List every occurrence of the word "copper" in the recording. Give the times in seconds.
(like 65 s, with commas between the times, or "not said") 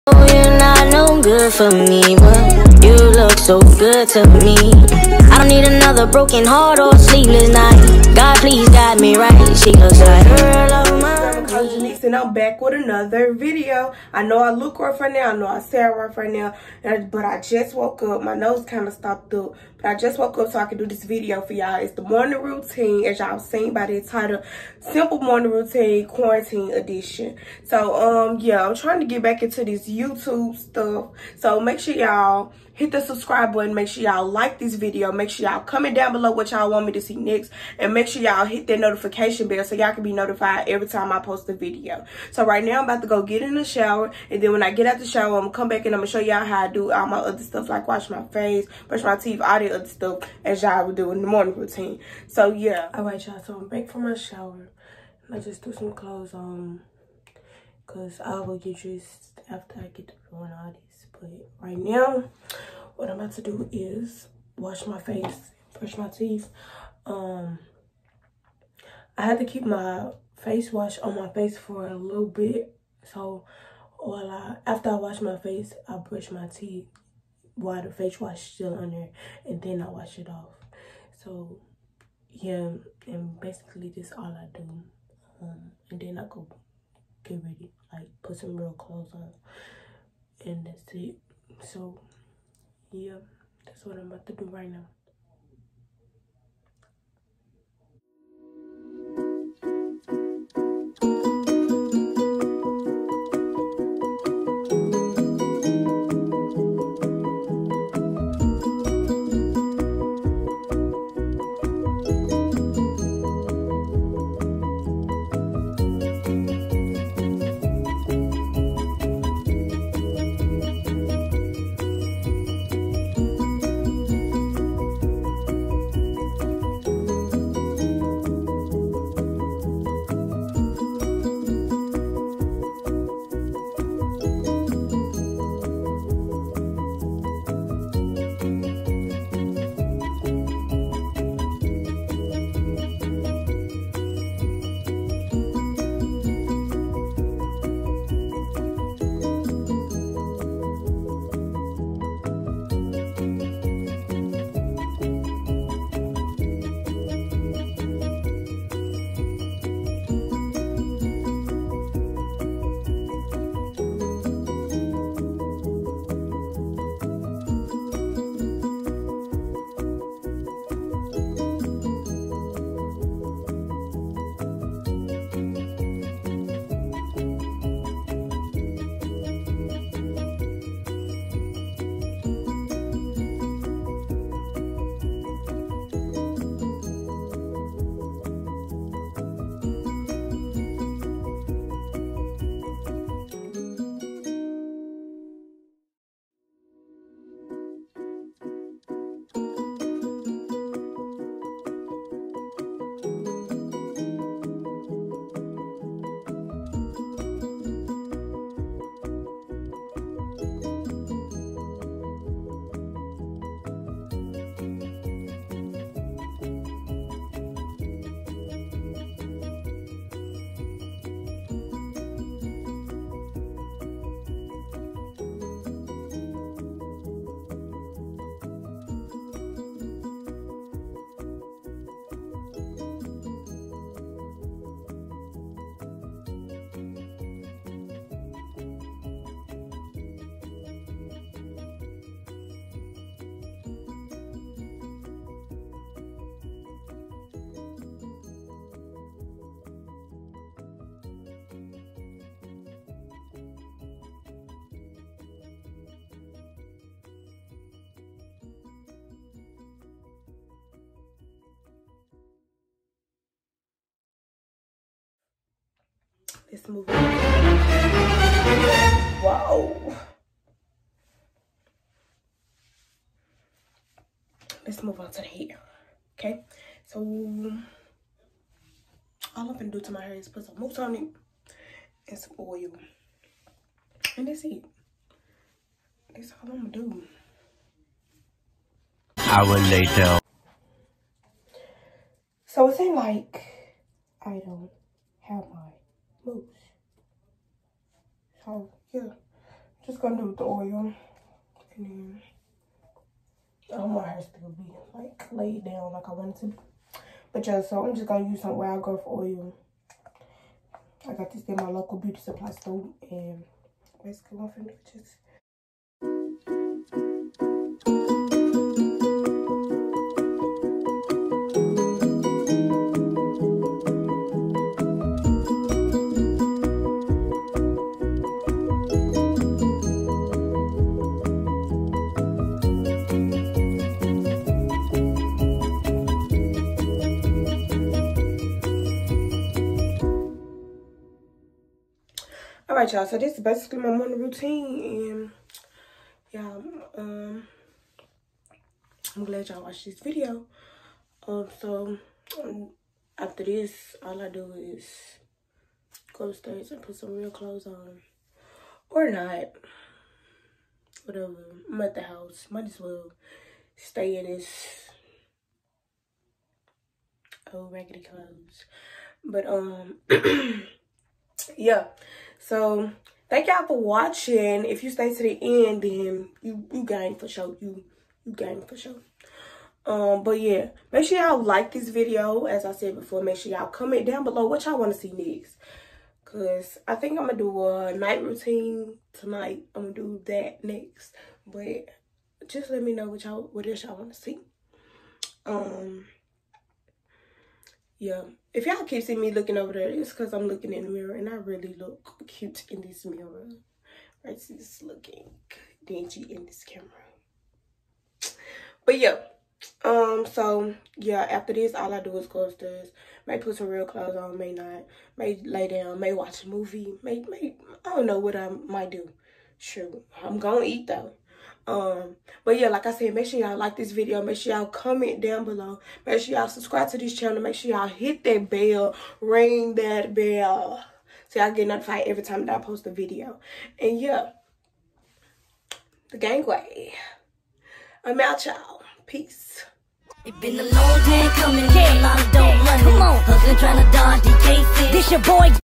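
not said.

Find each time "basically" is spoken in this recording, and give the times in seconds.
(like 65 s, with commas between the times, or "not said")
83 s, 314 s, 343 s.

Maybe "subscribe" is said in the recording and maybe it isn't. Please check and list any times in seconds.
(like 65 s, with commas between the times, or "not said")
33 s, 426 s.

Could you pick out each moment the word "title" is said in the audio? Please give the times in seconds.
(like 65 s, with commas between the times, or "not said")
24 s.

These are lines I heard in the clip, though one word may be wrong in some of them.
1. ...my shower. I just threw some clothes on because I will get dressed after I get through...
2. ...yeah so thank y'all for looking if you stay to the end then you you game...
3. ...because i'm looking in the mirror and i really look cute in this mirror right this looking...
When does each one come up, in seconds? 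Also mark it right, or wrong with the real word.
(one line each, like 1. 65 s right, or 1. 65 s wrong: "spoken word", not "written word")
1. 54 s right
2. 371 s wrong: "watching", not "looking"
3. 400 s right.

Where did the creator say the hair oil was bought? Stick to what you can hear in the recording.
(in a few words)
Local beauty supply store.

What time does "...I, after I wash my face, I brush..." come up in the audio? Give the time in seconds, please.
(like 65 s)
74 s.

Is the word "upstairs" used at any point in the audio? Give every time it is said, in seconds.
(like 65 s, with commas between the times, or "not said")
356 s, 412 s.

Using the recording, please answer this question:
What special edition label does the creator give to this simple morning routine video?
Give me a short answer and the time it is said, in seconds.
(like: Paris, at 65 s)
Quarantine edition, at 26 s.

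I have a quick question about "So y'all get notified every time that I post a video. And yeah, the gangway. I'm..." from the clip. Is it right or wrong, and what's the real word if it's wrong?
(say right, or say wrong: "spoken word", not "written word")
right.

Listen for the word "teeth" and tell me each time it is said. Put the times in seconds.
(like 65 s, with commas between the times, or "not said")
49 s, 66 s, 76 s.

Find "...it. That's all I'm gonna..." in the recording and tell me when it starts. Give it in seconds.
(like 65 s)
284 s.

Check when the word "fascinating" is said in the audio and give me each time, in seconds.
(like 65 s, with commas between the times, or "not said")
not said.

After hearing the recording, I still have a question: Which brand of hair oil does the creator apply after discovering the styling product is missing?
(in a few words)
Wild Growth.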